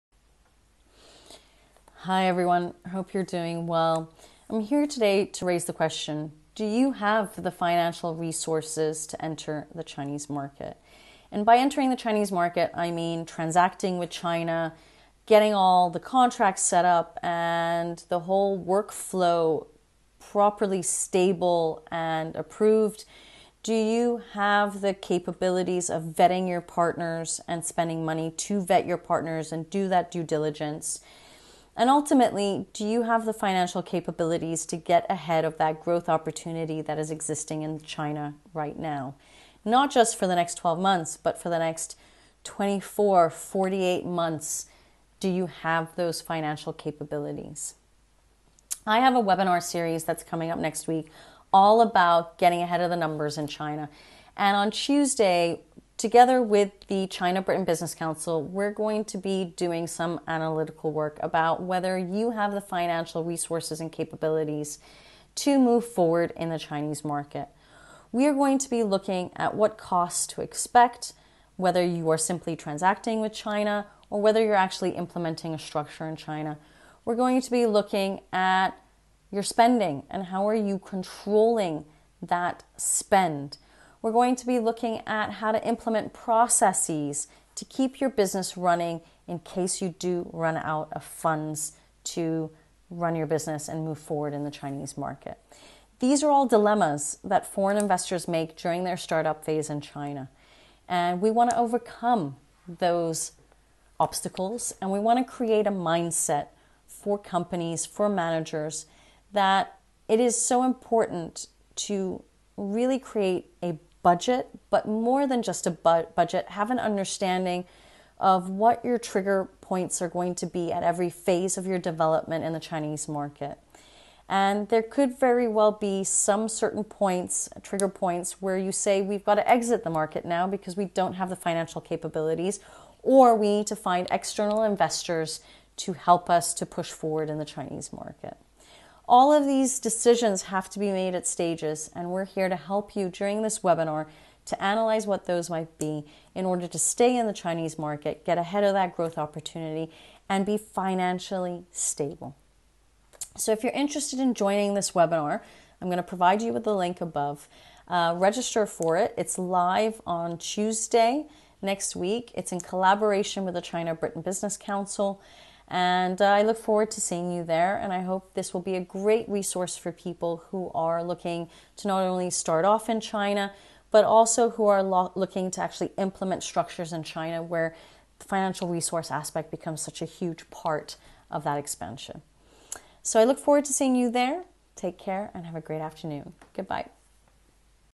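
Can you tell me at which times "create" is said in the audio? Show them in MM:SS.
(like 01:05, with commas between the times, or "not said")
01:45, 01:52.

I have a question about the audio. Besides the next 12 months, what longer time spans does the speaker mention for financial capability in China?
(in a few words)
24, 48 months.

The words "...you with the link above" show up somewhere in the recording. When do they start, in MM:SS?
02:36.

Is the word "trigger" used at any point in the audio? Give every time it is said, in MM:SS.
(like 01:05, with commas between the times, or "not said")
01:58, 02:07.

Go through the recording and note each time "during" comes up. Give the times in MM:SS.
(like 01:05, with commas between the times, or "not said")
01:38, 02:23.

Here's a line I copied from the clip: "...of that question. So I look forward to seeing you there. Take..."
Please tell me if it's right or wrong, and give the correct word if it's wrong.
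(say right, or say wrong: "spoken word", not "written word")
wrong: "expansion", not "question".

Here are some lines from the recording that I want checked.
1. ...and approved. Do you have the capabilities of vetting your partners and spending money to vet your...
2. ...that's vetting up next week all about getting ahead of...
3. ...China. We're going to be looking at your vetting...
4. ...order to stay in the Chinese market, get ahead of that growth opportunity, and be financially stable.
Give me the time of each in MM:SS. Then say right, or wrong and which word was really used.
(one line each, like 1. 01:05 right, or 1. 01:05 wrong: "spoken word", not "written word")
1. 00:21 right
2. 00:50 wrong: "coming", not "vetting"
3. 01:16 wrong: "spending", not "vetting"
4. 02:26 right.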